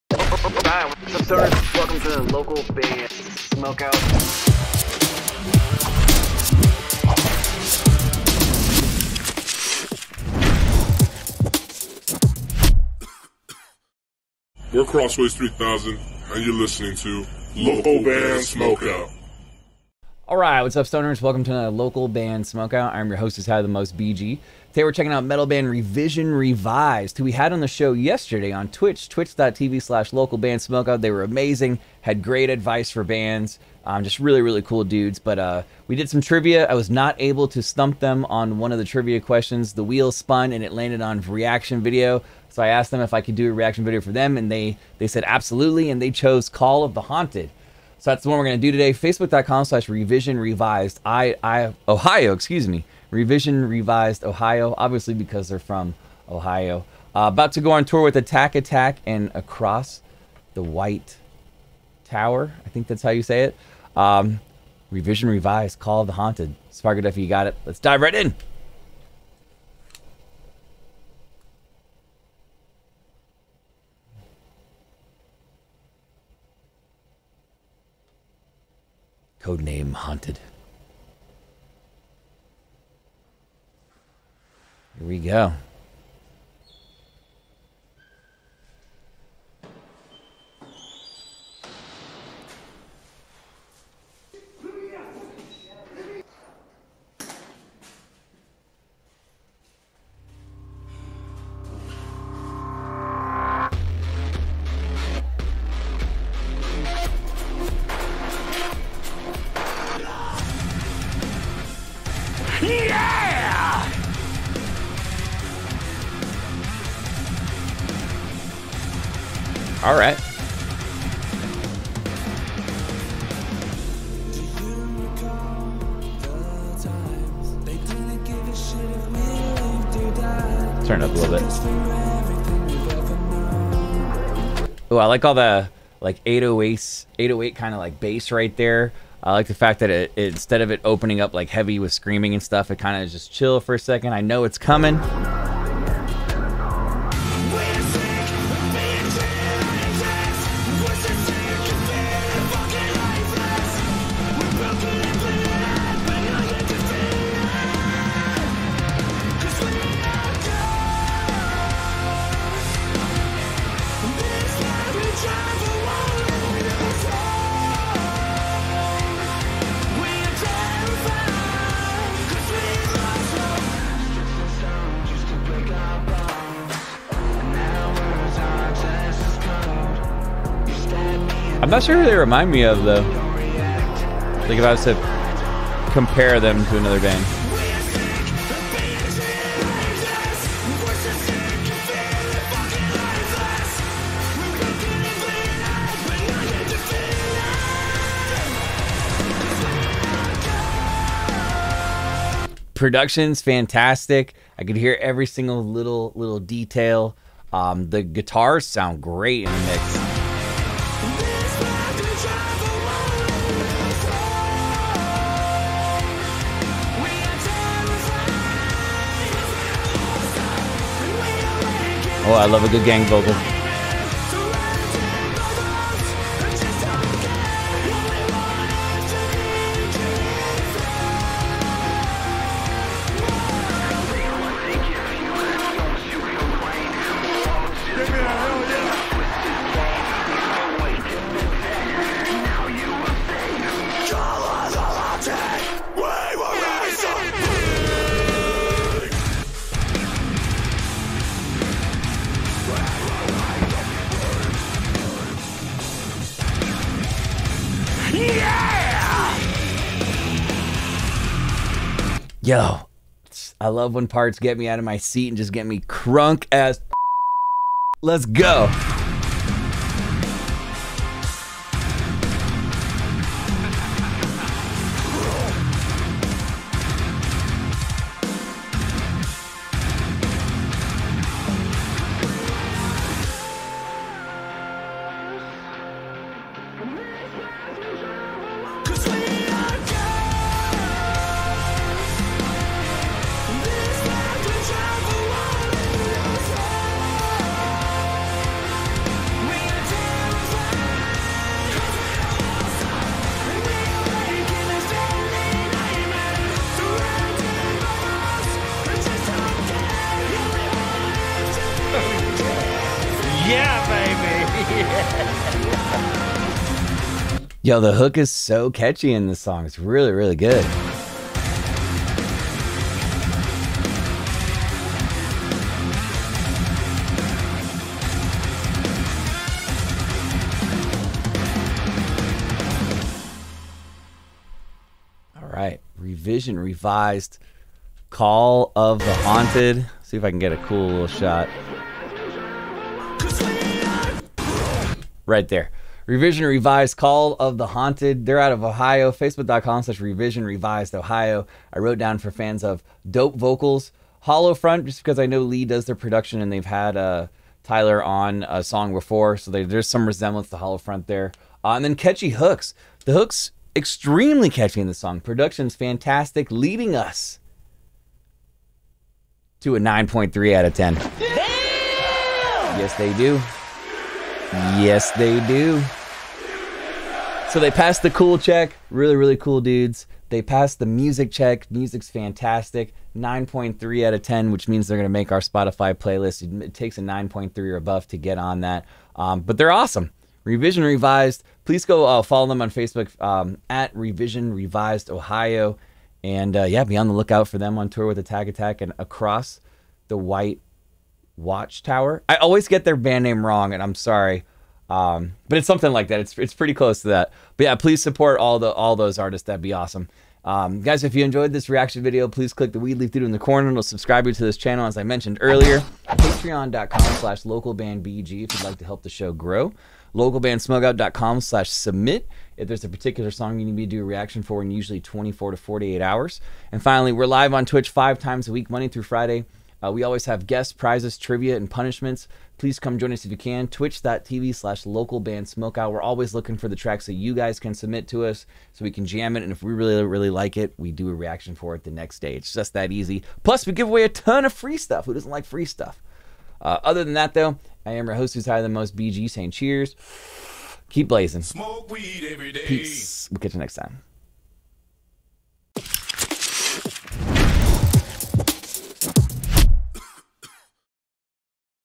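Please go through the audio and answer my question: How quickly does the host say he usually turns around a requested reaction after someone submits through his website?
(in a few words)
24 to 48 hours.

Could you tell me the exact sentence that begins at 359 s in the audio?
So they, there's some resemblance to Hollow Front there.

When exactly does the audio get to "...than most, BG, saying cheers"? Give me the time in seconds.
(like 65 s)
448 s.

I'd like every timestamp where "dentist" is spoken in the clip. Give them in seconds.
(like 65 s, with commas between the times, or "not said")
not said.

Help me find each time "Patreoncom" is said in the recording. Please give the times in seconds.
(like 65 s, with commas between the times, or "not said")
416 s.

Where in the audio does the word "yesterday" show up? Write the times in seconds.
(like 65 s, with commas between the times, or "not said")
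27 s.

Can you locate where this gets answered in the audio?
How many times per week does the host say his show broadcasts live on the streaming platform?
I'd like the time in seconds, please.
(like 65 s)
427 s.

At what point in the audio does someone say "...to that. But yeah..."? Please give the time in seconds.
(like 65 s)
407 s.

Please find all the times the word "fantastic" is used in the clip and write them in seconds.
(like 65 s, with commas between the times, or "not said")
203 s, 365 s, 382 s.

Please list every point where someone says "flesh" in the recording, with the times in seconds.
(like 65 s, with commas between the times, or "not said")
not said.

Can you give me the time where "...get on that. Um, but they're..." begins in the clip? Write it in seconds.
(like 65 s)
388 s.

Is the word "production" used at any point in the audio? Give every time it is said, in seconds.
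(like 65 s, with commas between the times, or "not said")
202 s, 355 s, 365 s.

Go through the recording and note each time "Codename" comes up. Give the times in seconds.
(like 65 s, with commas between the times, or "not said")
79 s.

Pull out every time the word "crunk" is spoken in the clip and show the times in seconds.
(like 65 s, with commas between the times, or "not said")
265 s.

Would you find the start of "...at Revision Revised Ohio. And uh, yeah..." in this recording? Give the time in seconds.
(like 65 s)
393 s.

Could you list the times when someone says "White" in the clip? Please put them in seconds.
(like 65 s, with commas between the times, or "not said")
60 s, 400 s.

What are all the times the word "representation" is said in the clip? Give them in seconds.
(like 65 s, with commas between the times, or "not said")
not said.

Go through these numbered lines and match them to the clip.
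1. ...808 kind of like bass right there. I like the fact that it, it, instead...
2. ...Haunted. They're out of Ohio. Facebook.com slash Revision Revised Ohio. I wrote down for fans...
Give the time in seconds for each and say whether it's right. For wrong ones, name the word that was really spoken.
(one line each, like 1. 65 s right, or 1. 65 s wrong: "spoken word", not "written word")
1. 137 s right
2. 347 s right.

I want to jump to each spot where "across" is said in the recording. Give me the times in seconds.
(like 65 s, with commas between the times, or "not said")
59 s, 398 s.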